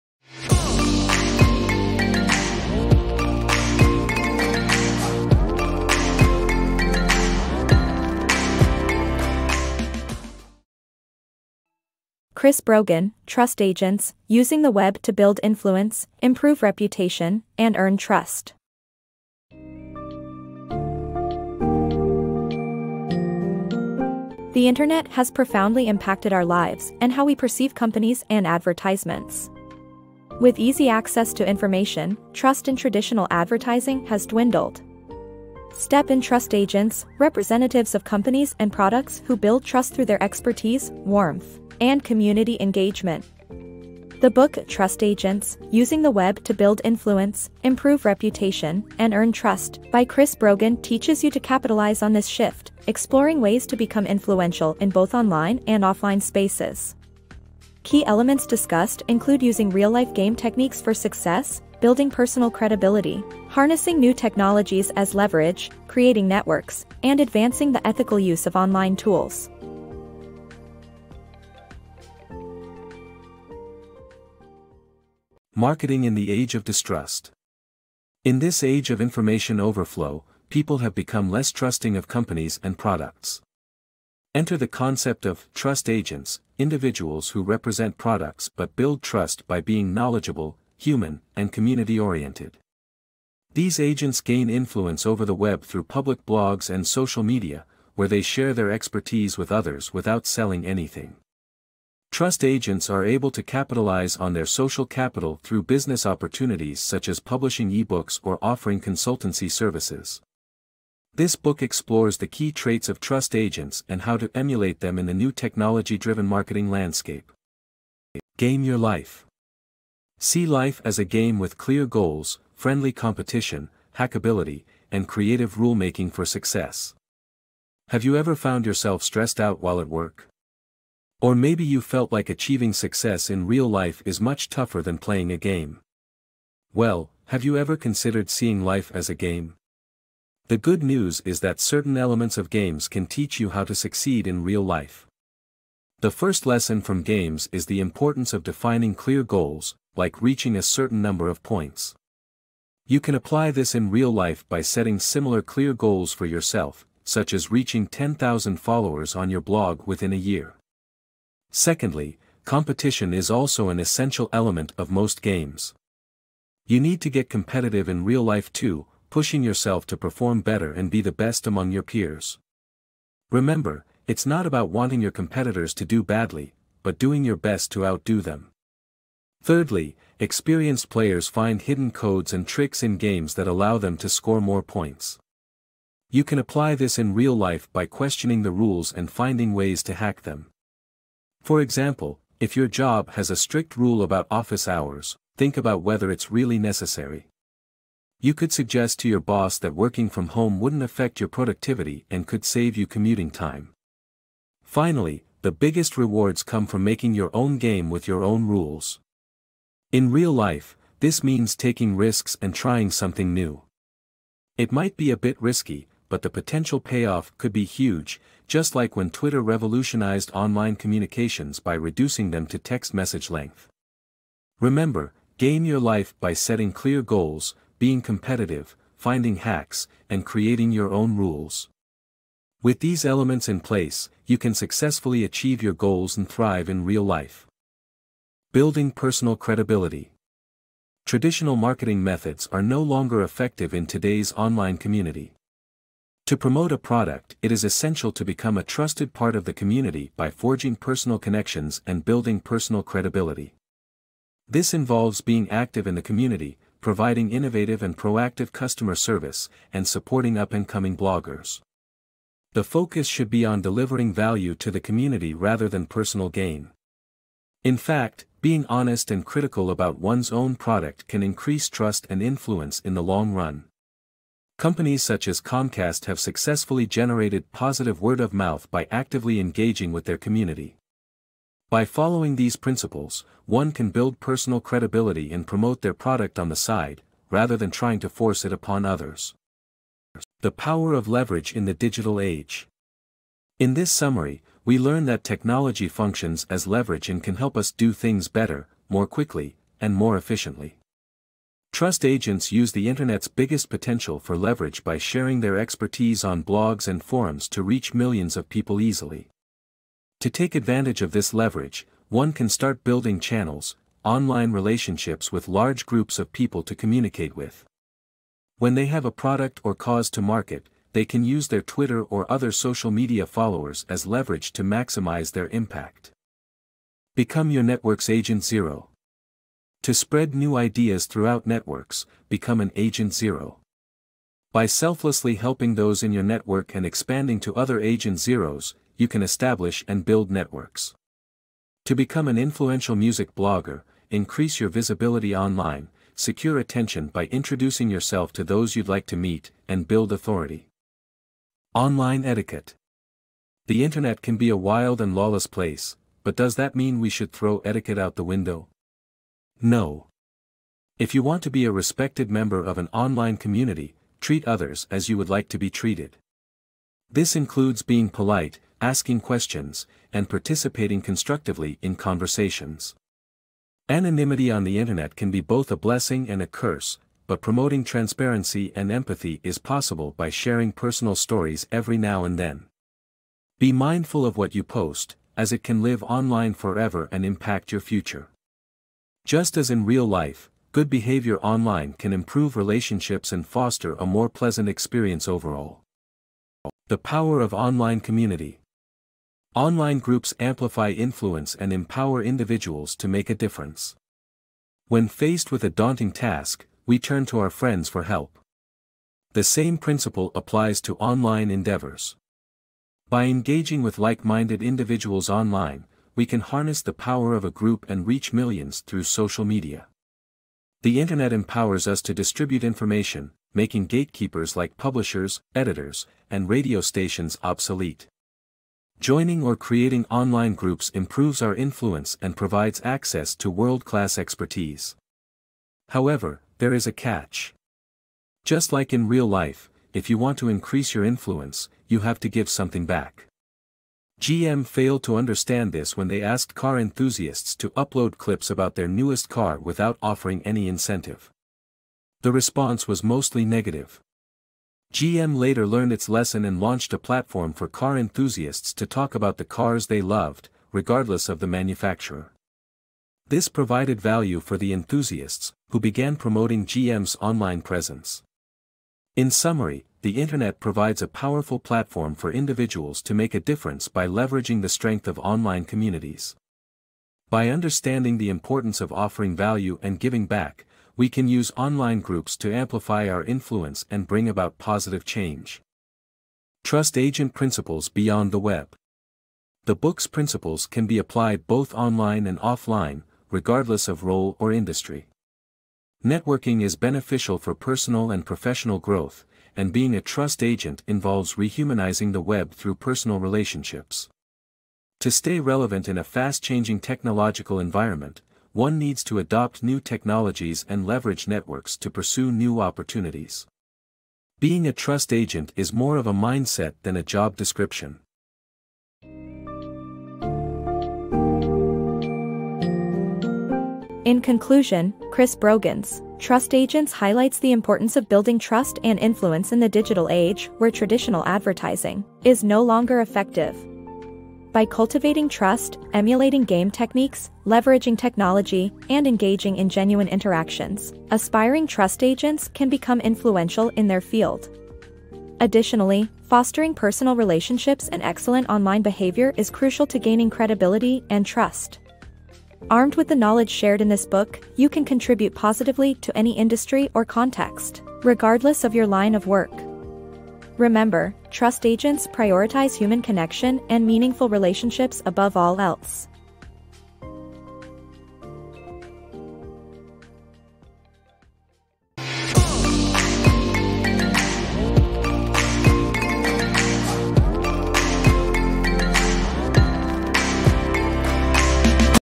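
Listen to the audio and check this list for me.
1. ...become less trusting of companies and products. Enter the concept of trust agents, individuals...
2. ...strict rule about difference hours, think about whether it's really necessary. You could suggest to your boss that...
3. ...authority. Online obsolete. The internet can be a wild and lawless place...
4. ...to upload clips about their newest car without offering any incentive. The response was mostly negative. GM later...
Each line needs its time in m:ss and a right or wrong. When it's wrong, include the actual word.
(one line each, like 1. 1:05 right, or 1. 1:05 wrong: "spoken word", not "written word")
1. 1:20 right
2. 3:13 wrong: "office", not "difference"
3. 5:50 wrong: "etiquette", not "obsolete"
4. 7:27 right.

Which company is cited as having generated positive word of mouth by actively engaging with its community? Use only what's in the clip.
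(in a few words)
Comcast.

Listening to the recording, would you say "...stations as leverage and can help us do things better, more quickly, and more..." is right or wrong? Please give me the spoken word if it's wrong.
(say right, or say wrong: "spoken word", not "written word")
wrong: "functions", not "stations".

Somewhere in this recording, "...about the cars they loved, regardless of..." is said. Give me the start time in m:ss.
7:39.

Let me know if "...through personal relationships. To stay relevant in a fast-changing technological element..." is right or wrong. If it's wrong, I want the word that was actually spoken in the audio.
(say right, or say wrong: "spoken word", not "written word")
wrong: "environment", not "element".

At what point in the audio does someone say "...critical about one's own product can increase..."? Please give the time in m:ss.
4:29.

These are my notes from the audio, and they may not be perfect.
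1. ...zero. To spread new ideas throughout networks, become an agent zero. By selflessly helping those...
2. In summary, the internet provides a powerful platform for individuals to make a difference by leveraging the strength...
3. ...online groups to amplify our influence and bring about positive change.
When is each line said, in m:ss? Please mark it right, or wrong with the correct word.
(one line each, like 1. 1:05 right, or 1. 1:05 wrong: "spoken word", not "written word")
1. 5:28 right
2. 7:49 right
3. 8:01 right.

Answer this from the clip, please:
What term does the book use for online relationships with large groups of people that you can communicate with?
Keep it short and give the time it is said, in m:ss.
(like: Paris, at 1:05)
Channels, at 5:13.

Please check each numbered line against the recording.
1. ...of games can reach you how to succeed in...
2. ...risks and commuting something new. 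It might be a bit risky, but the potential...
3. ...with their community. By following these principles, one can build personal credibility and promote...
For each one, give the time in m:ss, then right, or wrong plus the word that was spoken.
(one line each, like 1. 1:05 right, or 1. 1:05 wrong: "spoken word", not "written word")
1. 2:22 wrong: "teach", not "reach"
2. 3:31 wrong: "trying", not "commuting"
3. 4:39 right.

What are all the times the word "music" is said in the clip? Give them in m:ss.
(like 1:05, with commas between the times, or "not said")
5:42.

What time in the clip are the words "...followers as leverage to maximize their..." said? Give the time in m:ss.
5:23.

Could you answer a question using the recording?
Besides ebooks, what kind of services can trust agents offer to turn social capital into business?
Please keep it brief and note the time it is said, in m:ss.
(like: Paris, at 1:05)
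Consultancy services, at 1:48.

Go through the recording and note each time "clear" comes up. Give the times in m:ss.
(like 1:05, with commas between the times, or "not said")
2:01, 2:28, 2:35, 3:46.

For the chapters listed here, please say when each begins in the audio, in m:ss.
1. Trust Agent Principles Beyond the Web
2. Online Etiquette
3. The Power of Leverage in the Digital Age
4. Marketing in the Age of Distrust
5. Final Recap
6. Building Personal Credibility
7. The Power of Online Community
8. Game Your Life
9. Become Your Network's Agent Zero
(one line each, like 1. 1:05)
1. 8:07
2. 5:52
3. 4:51
4. 1:16
5. 8:39
6. 3:59
7. 6:37
8. 1:59
9. 5:27.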